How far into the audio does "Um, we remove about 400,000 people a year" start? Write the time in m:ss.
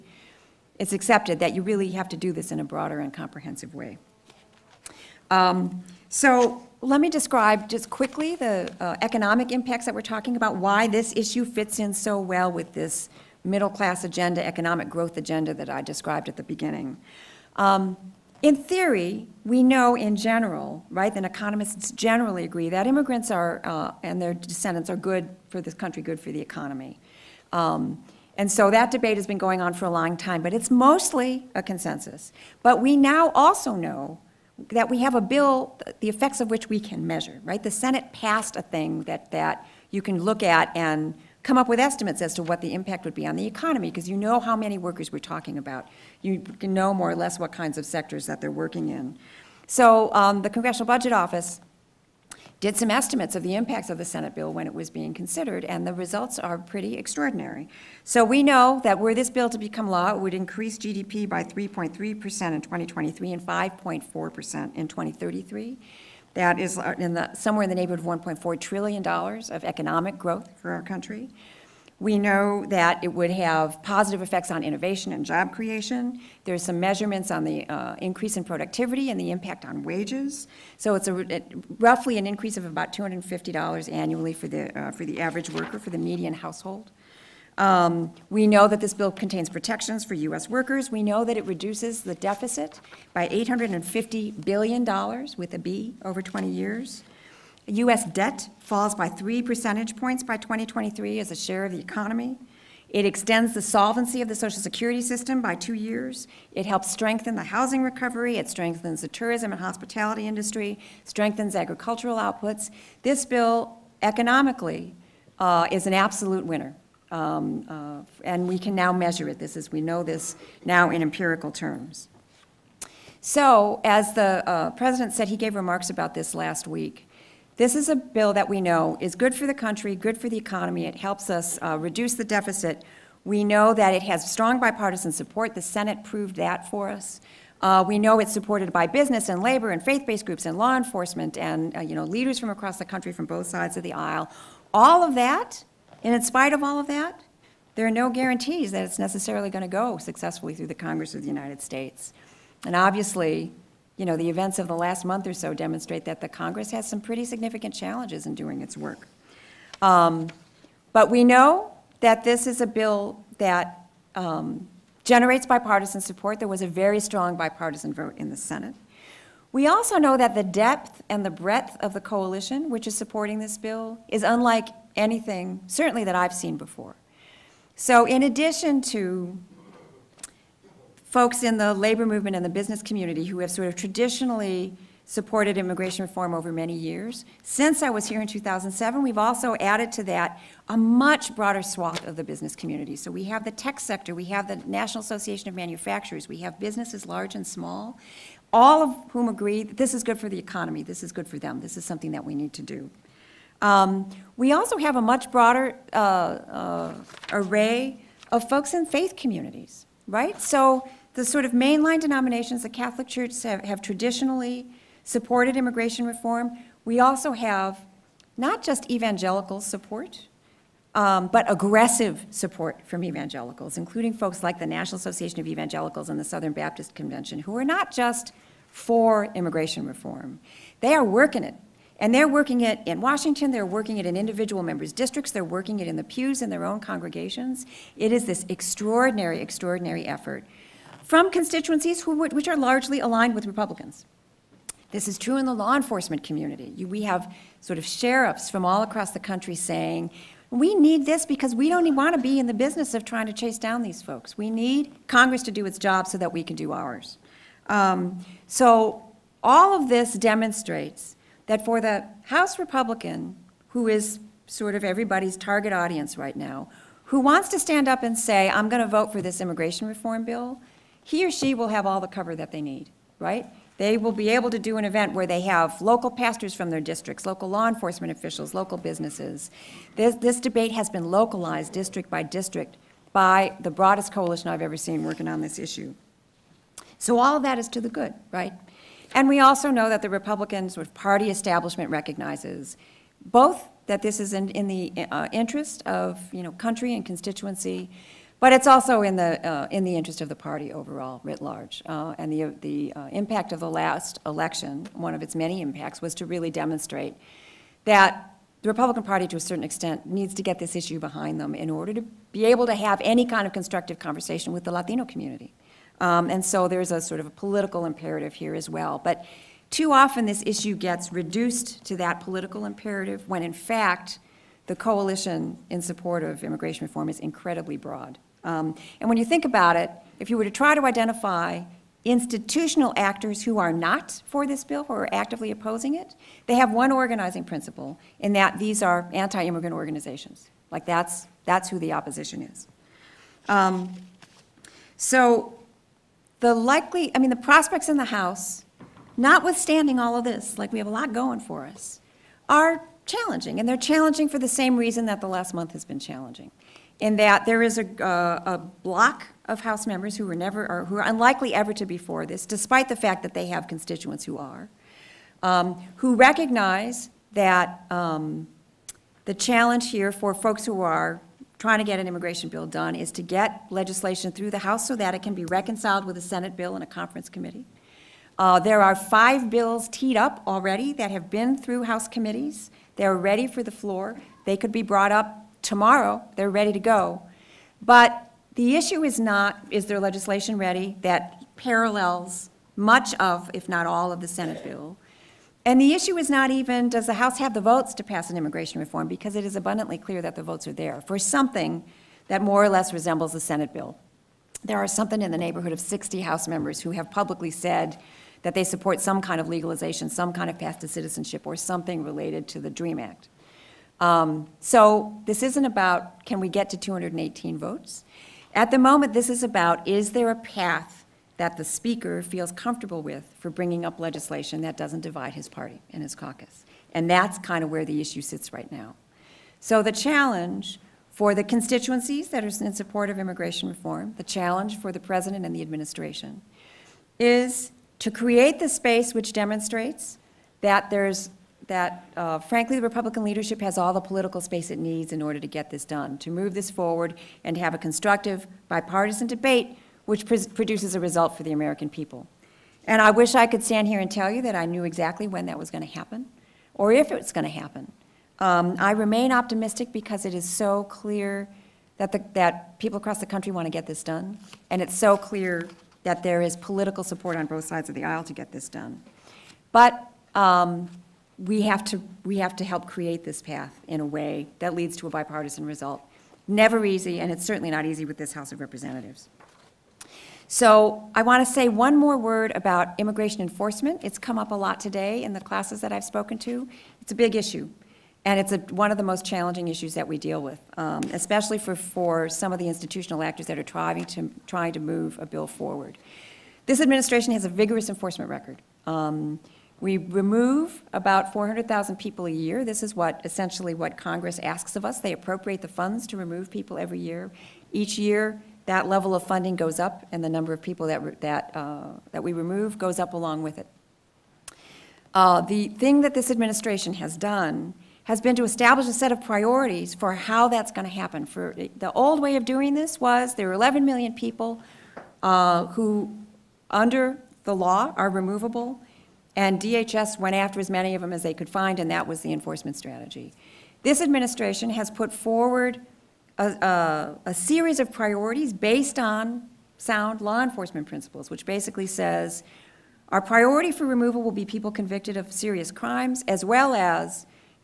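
8:18.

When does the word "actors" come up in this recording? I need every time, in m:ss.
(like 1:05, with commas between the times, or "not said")
5:32, 8:13.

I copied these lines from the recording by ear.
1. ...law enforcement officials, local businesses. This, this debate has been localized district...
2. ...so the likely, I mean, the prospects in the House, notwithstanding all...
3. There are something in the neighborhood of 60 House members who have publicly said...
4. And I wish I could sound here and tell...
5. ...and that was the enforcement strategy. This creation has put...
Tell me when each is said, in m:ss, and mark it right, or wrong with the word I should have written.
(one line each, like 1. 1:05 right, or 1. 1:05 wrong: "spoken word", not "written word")
1. 4:37 right
2. 5:44 right
3. 6:44 right
4. 7:32 wrong: "stand", not "sound"
5. 8:51 wrong: "administration", not "creation".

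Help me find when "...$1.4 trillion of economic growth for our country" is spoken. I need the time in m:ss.
1:08.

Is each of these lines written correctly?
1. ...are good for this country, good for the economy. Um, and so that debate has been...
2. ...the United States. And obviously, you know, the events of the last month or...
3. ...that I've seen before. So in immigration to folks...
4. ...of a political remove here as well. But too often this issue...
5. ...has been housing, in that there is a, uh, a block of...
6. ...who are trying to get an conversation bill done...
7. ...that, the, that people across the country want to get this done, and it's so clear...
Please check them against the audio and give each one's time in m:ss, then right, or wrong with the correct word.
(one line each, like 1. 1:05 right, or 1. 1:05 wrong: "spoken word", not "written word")
1. 0:24 right
2. 2:31 right
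3. 2:56 wrong: "addition", not "immigration"
4. 5:17 wrong: "imperative", not "remove"
5. 5:55 wrong: "challenging", not "housing"
6. 6:10 wrong: "immigration", not "conversation"
7. 7:41 right.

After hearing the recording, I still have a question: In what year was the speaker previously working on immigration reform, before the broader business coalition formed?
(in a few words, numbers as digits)
2007.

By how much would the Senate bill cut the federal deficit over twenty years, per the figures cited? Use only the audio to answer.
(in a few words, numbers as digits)
$850 billion.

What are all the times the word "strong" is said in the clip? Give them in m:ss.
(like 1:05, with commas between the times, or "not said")
2:14, 2:46.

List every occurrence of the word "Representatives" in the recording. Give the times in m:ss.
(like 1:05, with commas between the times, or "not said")
7:58.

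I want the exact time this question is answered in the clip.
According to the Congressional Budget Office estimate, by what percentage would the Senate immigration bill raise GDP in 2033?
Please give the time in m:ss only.
1:03.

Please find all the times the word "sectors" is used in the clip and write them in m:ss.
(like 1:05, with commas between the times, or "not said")
0:47, 3:13.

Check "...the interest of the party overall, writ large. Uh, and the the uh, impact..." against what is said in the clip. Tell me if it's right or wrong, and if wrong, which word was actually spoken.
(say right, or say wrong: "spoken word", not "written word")
right.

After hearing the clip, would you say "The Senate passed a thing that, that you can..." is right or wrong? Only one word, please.
right.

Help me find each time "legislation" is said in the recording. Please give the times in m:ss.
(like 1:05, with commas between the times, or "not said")
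6:13, 6:29, 7:03.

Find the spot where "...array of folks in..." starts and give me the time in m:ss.
3:27.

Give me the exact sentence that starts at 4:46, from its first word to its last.
So all that is to the good, right?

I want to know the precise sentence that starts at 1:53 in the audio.
This bill, economically, uh, is an absolute winner um, uh, and we can now measure it.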